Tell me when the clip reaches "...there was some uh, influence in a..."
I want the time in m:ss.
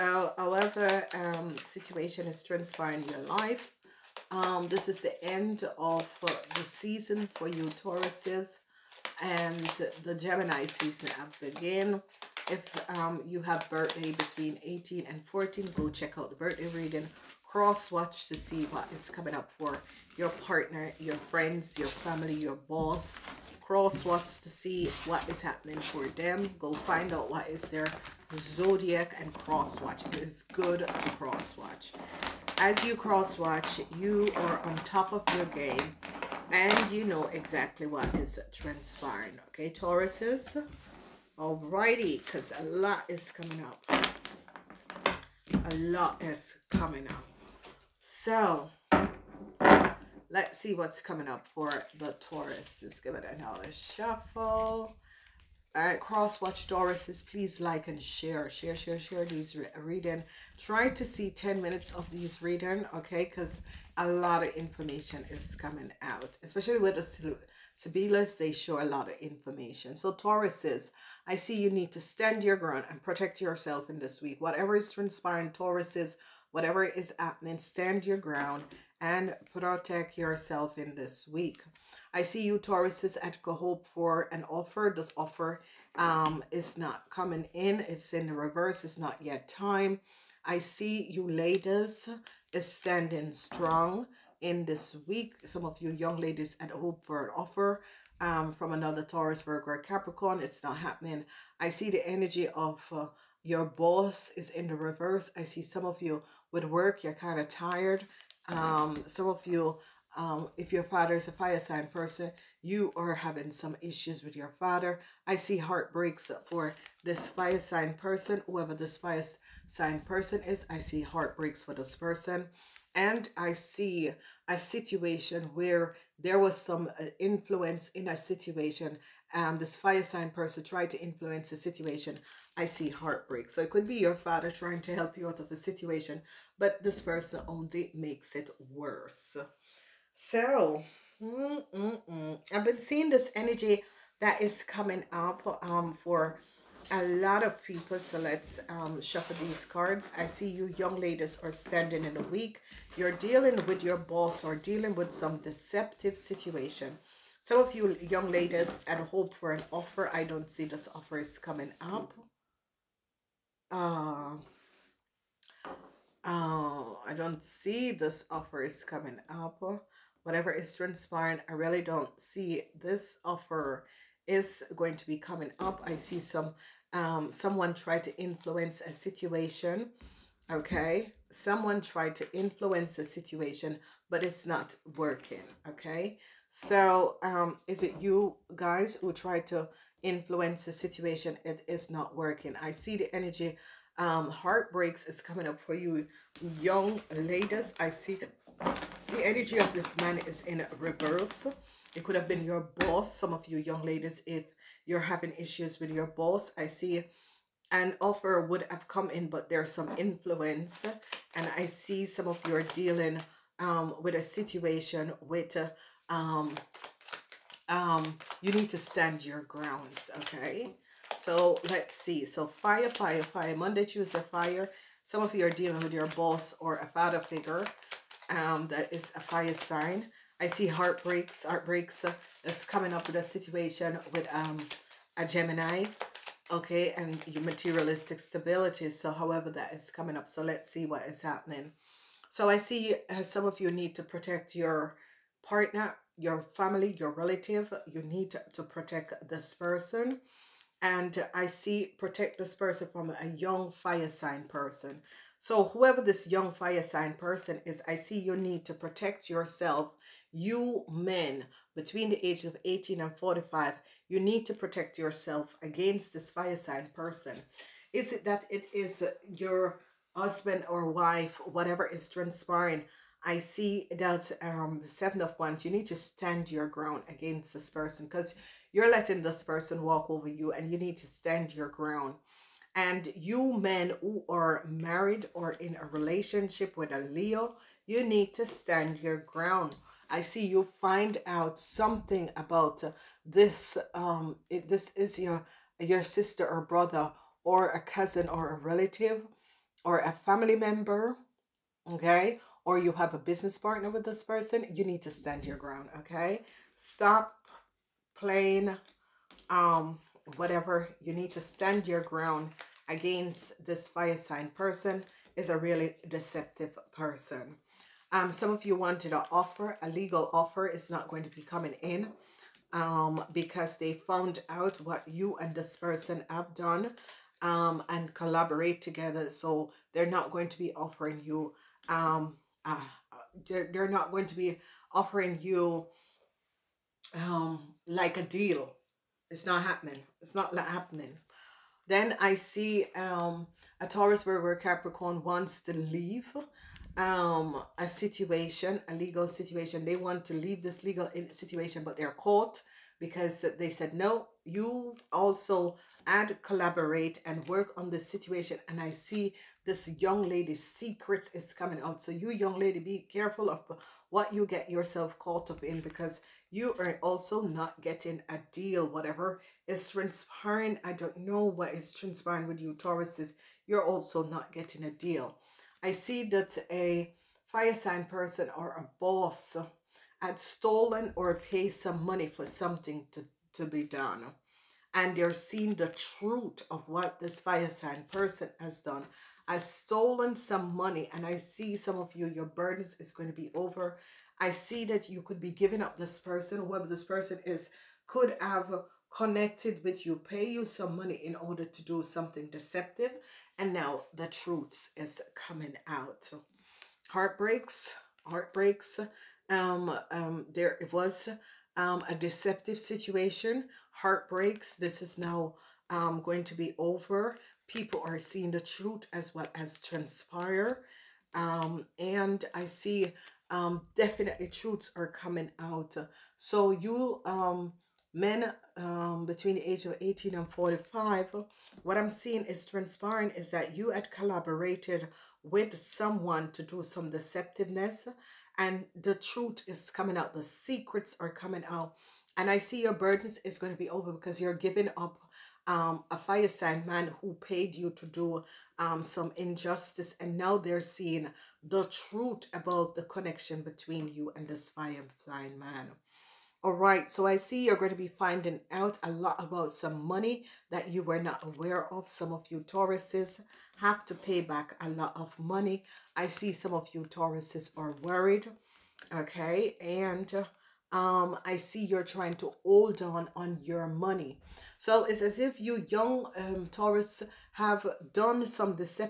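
2:06.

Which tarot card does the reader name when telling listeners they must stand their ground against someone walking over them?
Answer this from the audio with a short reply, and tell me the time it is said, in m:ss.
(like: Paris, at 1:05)
Seven of Wands, at 4:34.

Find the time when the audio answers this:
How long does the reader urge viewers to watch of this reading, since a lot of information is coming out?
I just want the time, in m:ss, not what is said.
1:01.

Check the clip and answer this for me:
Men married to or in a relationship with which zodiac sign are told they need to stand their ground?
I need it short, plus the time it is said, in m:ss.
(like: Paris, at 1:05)
Leo, at 4:47.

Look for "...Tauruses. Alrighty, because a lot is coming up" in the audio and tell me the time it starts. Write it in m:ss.
0:39.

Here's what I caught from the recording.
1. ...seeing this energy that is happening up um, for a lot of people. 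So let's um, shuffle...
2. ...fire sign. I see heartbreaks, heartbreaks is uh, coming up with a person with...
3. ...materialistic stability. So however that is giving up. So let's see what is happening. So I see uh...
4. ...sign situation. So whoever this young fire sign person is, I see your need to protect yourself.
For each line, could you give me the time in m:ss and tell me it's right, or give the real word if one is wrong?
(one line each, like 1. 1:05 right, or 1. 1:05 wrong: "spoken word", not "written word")
1. 2:22 wrong: "coming", not "happening"
2. 3:49 wrong: "situation", not "person"
3. 3:57 wrong: "coming", not "giving"
4. 4:14 wrong: "person", not "situation".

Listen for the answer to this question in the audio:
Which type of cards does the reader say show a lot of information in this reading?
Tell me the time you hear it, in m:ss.
1:07.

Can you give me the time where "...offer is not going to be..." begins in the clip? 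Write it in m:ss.
5:20.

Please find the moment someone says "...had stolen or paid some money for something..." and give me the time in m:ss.
6:20.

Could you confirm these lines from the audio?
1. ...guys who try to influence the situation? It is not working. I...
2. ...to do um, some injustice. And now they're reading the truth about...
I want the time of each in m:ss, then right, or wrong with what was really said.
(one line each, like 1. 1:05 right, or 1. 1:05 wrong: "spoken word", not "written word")
1. 3:08 right
2. 7:27 wrong: "seeing", not "reading".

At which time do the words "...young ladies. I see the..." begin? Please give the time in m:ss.
3:16.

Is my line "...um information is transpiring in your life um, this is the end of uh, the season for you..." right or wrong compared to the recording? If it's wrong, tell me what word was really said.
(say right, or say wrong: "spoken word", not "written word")
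wrong: "situation", not "information".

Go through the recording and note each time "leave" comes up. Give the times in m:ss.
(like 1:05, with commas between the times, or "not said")
5:45, 5:50.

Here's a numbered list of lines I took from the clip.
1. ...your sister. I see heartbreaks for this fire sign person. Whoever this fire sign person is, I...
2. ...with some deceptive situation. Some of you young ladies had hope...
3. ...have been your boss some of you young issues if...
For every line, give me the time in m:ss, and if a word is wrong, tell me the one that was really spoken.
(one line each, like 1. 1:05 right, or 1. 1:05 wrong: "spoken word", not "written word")
1. 1:54 wrong: "father", not "sister"
2. 2:34 right
3. 3:22 wrong: "ladies", not "issues".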